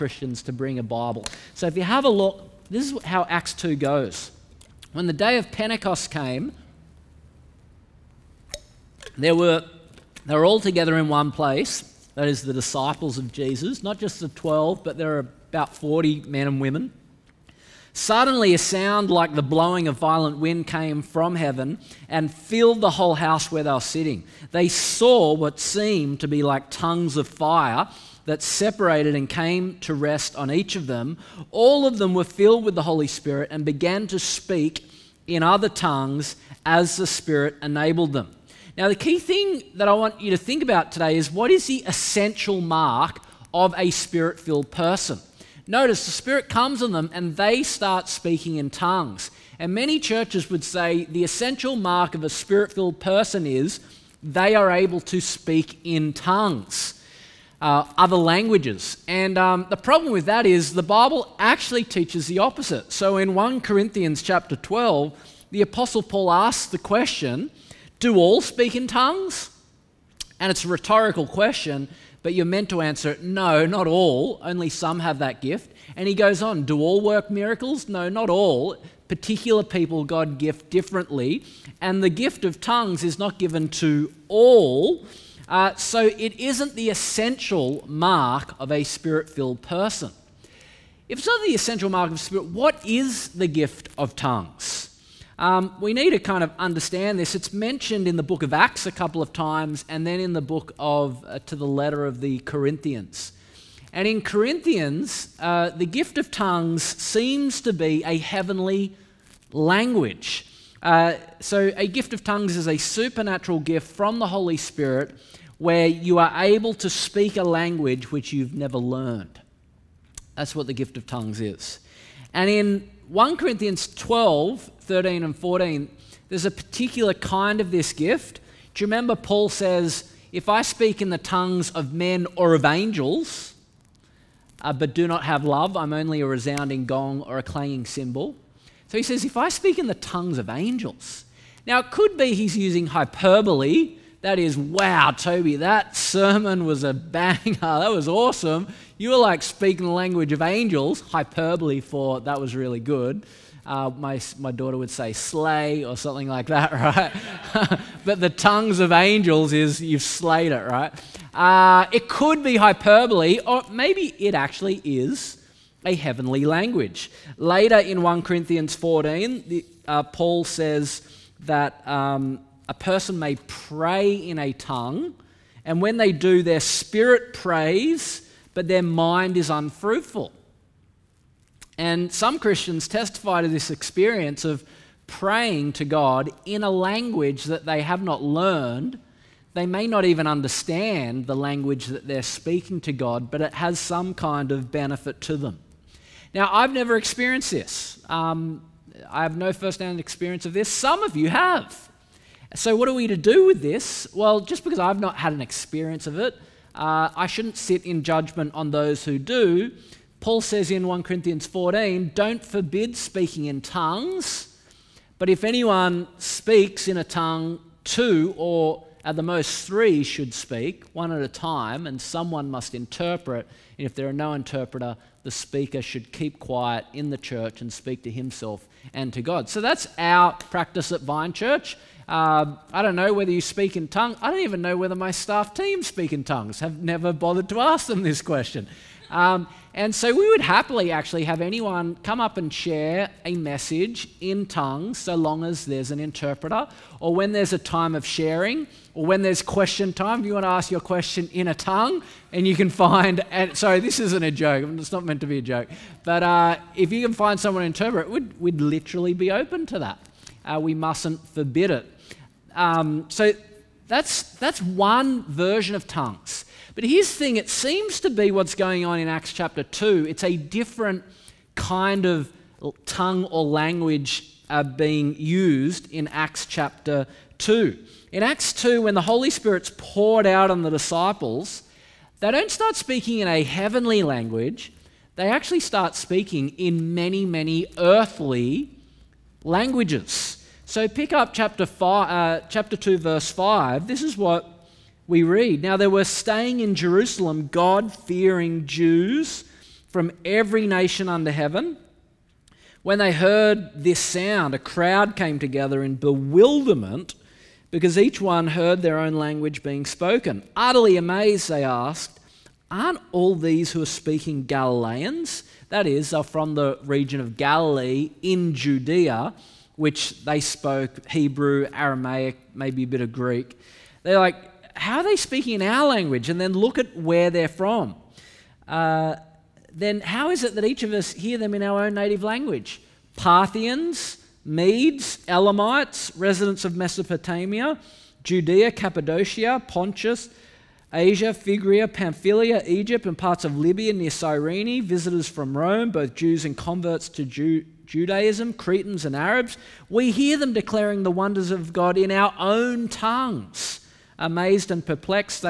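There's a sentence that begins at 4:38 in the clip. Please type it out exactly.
In Acts 2, when the Holy Spirit's poured out on the disciples, they don't start speaking in a heavenly language.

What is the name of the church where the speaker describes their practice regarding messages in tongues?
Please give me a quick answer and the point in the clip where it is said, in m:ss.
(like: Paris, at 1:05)
Vine Church, at 3:51.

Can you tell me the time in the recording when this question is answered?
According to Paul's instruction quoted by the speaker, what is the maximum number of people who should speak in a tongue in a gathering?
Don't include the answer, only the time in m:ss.
3:39.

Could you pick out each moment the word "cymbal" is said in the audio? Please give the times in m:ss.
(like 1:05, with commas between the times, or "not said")
2:17.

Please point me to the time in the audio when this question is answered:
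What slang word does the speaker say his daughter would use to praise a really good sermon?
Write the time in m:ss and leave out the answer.
2:35.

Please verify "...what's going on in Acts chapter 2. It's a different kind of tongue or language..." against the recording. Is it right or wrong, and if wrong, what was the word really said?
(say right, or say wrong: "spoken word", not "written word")
right.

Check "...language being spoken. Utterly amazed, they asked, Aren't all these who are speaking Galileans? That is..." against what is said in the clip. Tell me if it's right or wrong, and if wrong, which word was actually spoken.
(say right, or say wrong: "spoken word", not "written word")
right.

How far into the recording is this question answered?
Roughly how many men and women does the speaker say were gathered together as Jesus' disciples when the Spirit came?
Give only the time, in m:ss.
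0:15.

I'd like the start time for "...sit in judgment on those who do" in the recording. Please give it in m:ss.
3:27.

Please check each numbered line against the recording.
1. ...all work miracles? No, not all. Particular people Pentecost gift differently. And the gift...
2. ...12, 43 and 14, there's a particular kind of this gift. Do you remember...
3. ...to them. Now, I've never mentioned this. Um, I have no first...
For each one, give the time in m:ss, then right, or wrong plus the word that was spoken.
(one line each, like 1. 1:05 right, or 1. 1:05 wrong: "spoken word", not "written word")
1. 1:16 wrong: "God", not "Pentecost"
2. 2:03 wrong: "13", not "43"
3. 3:15 wrong: "experienced", not "mentioned".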